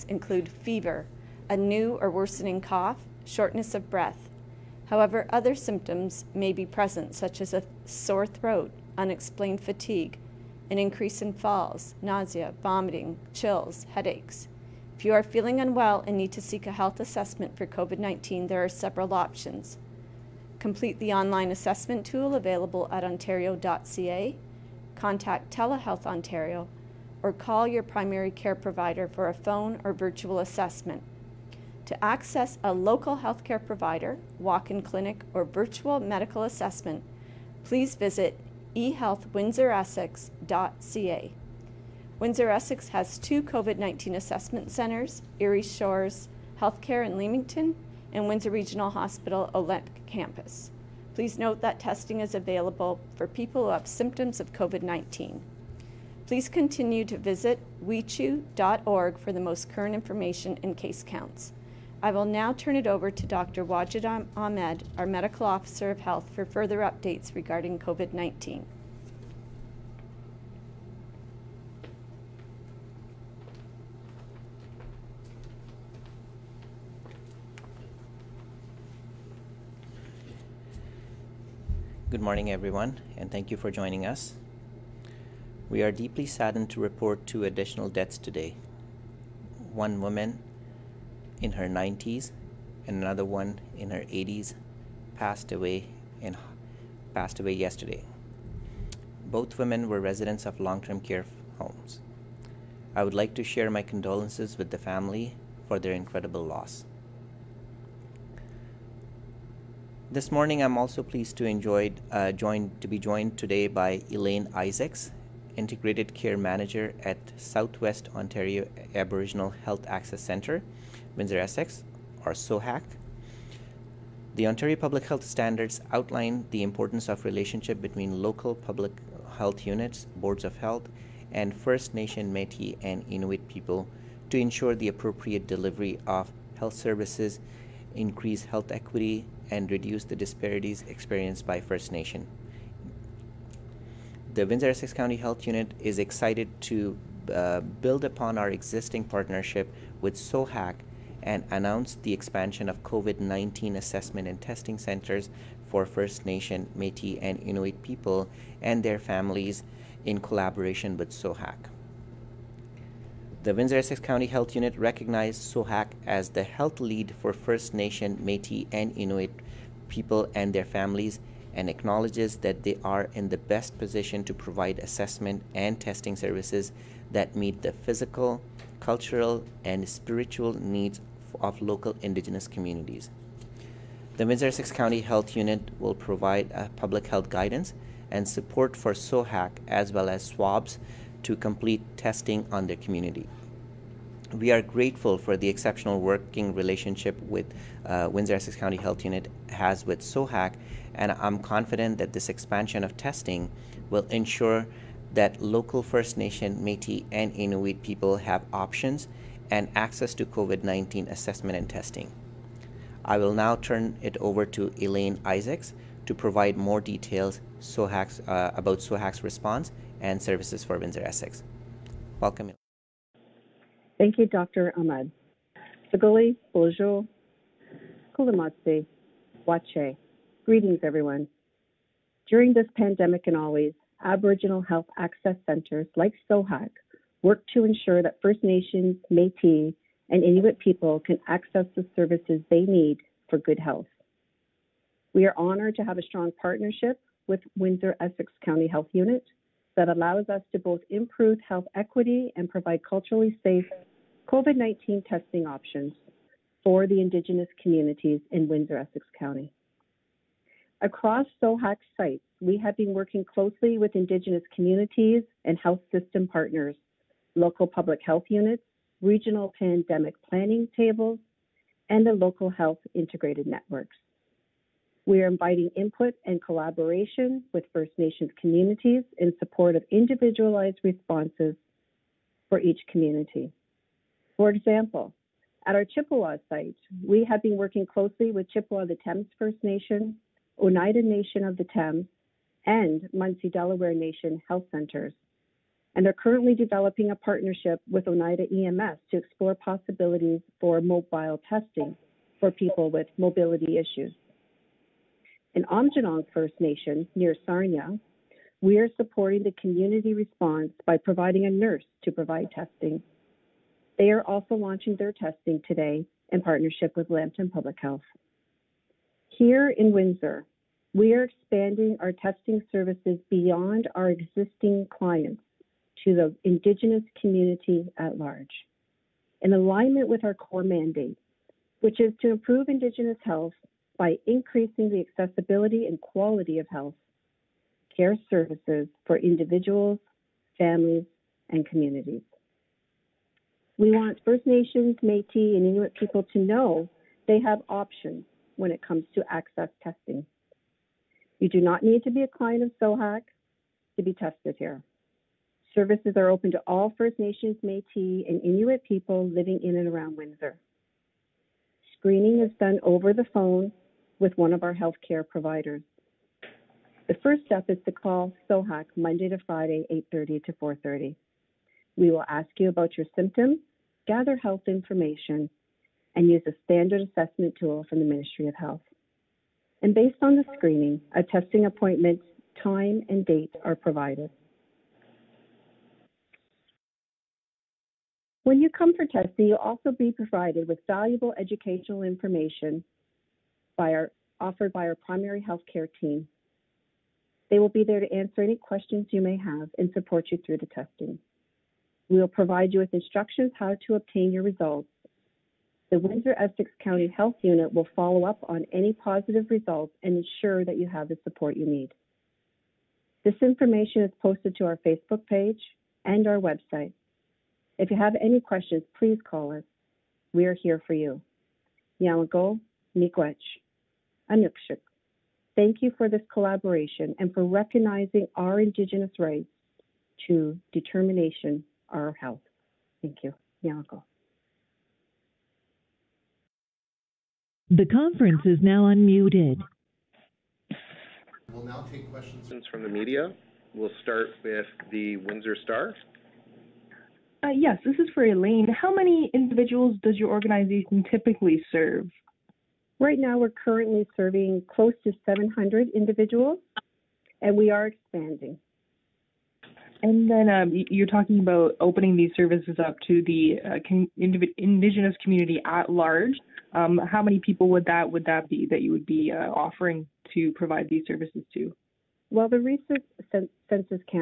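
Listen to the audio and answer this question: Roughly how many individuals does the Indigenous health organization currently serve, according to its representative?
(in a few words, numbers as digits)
700.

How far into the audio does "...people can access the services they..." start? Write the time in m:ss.
4:00.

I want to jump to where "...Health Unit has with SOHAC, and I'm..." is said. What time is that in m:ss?
3:18.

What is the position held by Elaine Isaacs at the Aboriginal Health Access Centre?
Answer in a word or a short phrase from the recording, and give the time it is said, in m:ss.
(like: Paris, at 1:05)
Integrated Care Manager, at 1:55.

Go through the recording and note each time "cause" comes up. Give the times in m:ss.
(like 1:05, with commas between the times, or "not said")
not said.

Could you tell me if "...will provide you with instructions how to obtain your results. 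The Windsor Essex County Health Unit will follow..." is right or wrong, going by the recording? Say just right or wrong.
right.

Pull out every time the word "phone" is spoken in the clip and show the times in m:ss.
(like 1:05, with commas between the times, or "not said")
0:29, 6:03.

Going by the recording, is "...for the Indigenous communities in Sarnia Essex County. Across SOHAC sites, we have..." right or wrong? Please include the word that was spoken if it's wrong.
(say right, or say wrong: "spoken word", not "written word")
wrong: "Windsor", not "Sarnia".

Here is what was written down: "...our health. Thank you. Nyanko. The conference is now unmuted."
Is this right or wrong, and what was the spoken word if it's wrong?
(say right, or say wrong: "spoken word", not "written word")
right.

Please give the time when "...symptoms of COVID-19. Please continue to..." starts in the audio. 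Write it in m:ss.
0:53.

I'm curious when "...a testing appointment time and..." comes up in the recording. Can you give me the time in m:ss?
6:21.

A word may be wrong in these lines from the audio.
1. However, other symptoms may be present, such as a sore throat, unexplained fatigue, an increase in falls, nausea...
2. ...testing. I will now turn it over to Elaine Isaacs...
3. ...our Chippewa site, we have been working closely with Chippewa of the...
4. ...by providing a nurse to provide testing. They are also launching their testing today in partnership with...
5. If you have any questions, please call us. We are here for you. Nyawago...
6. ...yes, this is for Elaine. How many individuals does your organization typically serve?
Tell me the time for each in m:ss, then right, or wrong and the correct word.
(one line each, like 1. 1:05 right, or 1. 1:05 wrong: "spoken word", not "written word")
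1. 0:04 right
2. 3:31 right
3. 4:45 right
4. 5:10 right
5. 6:57 right
6. 7:27 right.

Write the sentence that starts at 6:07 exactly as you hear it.
The first step is to call SOHAC Monday to Friday, 8:30 to 4:30.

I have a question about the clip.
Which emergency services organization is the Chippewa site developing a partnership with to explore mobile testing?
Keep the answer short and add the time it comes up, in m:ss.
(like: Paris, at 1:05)
Oneida EMS, at 4:58.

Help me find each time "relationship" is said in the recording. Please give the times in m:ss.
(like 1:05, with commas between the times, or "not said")
2:07, 3:16.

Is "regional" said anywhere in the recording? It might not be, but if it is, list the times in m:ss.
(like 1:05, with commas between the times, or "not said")
0:48, 4:29.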